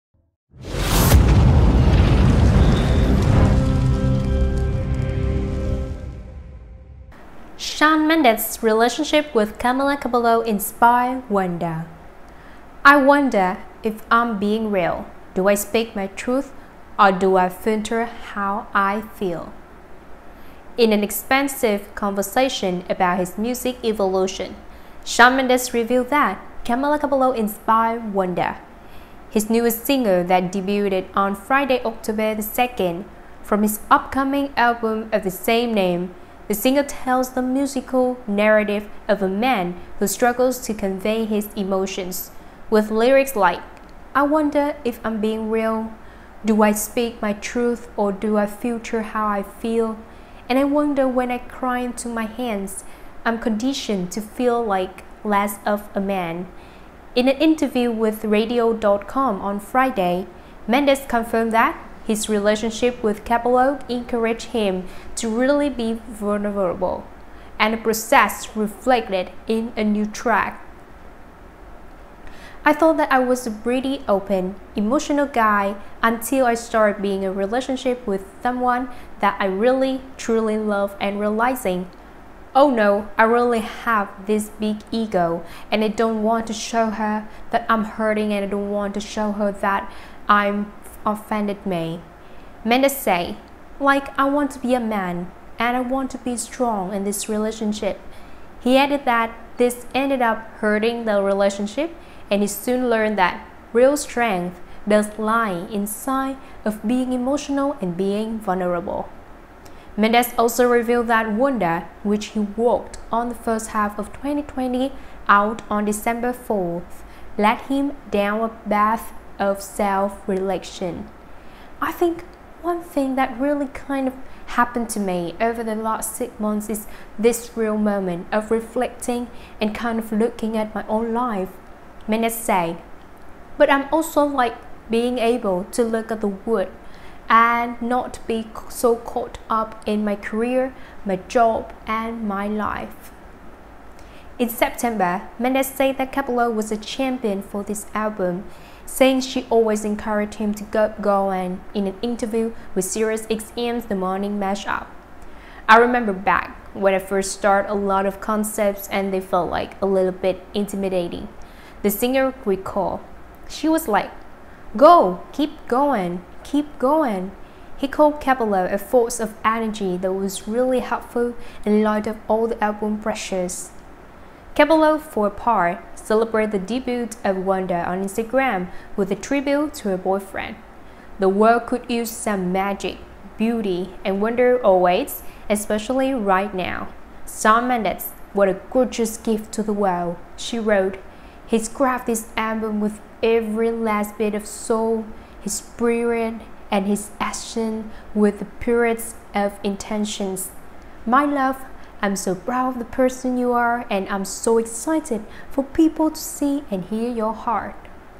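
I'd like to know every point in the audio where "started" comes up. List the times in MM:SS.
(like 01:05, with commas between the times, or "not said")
01:16, 02:37.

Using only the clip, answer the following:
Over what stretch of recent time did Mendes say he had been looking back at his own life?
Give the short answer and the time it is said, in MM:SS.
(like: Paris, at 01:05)
6 months, at 02:06.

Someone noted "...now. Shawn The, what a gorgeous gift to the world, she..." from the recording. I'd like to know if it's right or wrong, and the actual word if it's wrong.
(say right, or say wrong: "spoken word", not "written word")
wrong: "Mendes", not "The".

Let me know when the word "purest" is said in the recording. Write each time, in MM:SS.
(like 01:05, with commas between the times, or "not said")
03:18.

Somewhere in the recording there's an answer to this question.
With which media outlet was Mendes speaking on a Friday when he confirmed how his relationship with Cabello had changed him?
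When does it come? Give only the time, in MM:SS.
00:58.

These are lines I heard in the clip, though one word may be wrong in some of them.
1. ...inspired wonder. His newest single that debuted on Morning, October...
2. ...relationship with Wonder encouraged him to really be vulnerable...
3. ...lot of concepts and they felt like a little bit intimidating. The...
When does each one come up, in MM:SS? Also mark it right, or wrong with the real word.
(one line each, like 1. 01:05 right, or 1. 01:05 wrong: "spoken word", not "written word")
1. 00:27 wrong: "Friday", not "Morning"
2. 01:02 wrong: "Cabello", not "Wonder"
3. 02:37 right.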